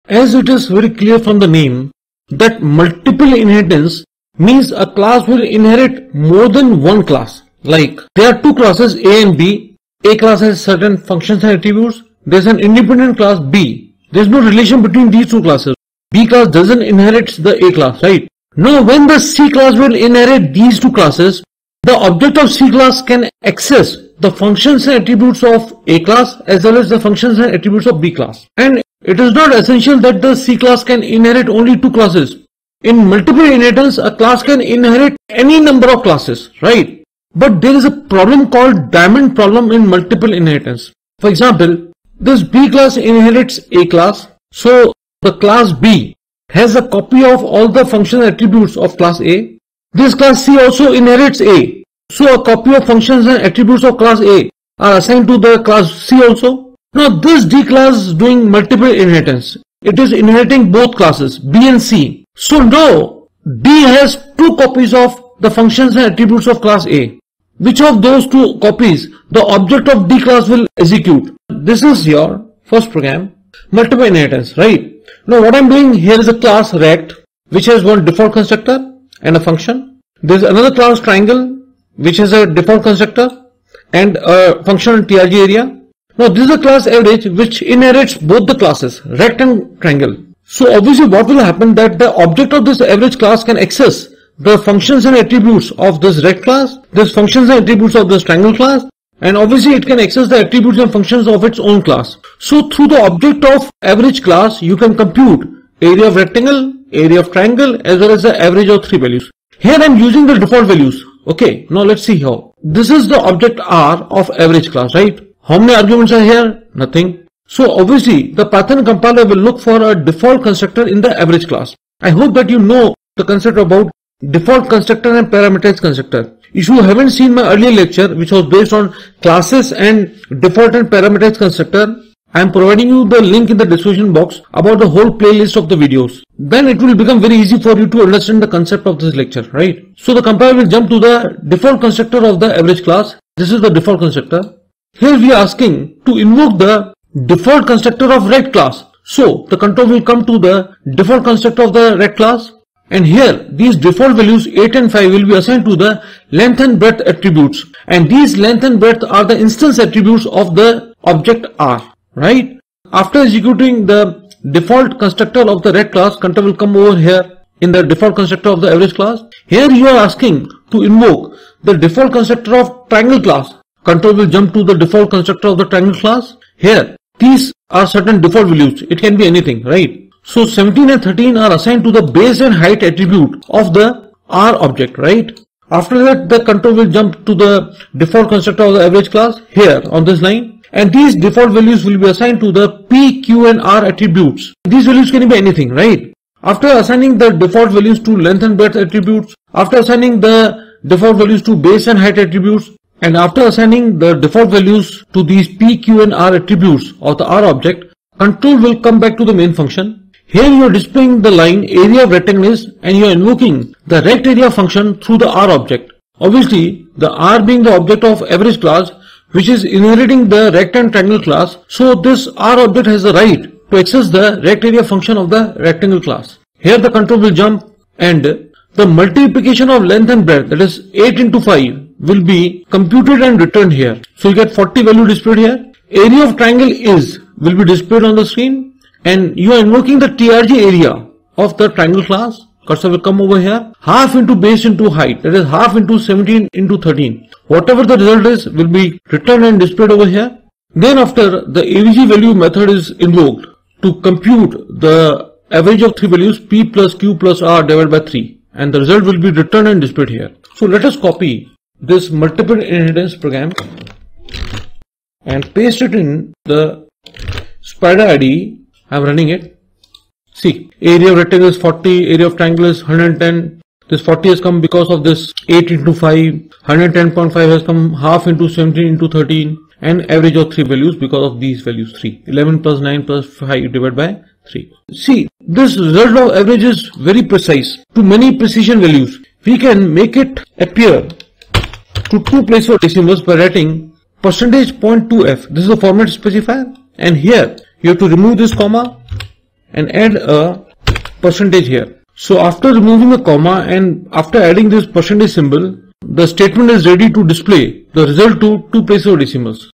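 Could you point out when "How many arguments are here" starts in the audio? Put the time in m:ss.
1:55.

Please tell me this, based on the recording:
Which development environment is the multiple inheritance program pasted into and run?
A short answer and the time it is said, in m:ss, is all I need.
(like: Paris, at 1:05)
Spyder, at 4:27.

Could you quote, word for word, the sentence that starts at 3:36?
Obviously, the R being the object of average class which is inheriting the rect and triangle class.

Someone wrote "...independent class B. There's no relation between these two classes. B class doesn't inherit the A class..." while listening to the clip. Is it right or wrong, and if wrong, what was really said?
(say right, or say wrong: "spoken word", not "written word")
right.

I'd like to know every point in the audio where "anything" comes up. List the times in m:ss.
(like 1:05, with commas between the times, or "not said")
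2:59, 3:15.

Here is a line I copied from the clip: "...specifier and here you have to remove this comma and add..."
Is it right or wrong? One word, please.
right.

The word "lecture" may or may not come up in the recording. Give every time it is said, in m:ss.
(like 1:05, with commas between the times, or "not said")
2:07, 2:19.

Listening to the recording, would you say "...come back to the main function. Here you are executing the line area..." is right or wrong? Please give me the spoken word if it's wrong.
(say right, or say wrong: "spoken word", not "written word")
wrong: "displaying", not "executing".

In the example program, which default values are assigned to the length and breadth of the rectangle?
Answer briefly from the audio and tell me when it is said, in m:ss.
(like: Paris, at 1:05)
8 and 5, at 2:34.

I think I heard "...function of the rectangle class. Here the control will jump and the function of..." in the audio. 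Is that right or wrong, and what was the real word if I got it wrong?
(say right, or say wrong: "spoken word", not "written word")
wrong: "multiplication", not "function".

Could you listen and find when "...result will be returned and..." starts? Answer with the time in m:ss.
4:18.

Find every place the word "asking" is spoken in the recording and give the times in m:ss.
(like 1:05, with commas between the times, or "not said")
2:25, 2:50.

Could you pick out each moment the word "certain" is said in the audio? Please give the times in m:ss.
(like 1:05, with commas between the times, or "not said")
0:10, 2:57.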